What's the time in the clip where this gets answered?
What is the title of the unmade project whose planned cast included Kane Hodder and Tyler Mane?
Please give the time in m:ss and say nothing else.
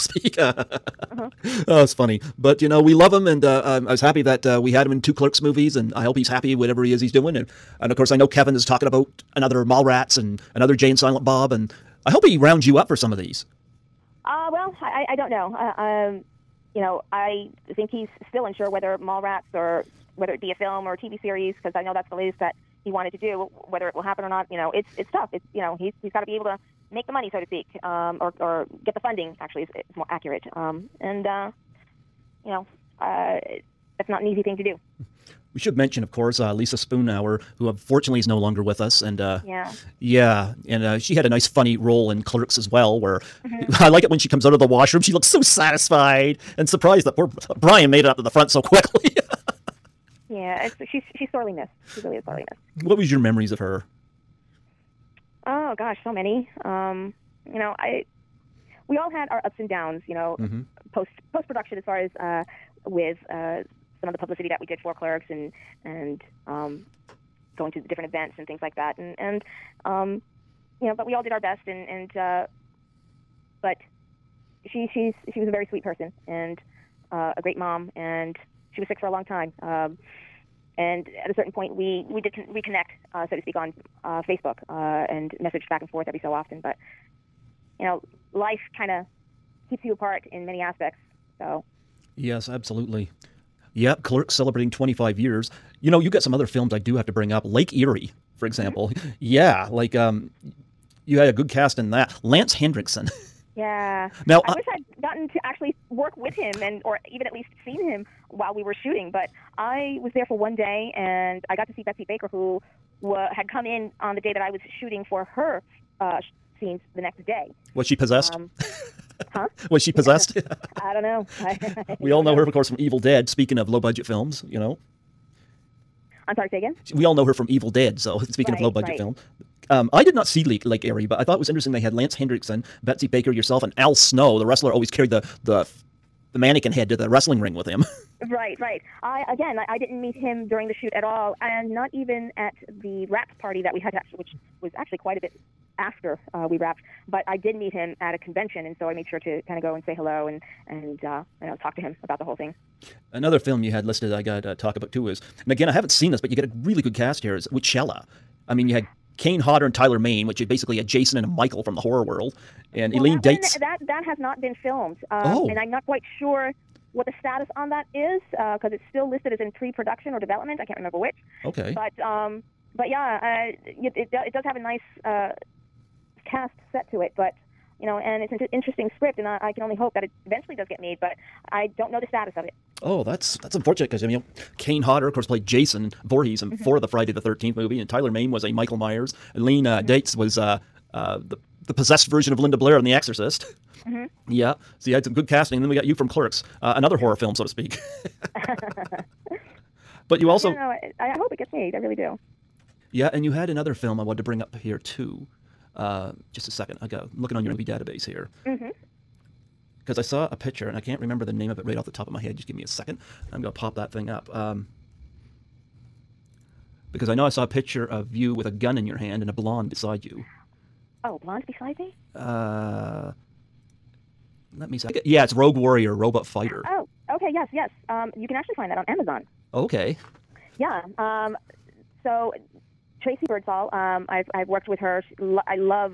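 2:37.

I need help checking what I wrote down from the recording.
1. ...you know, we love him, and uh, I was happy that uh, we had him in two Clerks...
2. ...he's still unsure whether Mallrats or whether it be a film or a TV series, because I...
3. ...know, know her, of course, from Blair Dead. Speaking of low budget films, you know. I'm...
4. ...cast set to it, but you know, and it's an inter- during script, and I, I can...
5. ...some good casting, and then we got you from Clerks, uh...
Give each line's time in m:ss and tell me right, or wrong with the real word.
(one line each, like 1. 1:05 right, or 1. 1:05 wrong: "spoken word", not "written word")
1. 0:02 right
2. 0:17 right
3. 2:02 wrong: "Evil", not "Blair"
4. 2:56 wrong: "interesting", not "during"
5. 3:15 right.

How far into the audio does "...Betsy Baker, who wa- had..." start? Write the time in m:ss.
1:51.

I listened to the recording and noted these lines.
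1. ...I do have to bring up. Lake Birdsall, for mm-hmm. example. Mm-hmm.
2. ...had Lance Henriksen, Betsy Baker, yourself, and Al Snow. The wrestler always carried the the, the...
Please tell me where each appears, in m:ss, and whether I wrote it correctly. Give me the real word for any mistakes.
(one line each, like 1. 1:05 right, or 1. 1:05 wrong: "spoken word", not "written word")
1. 1:36 wrong: "Eerie", not "Birdsall"
2. 2:11 right.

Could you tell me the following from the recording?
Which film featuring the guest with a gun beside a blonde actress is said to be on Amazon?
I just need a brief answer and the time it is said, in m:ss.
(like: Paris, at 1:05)
Rogue Warrior, Robot Fighter, at 3:45.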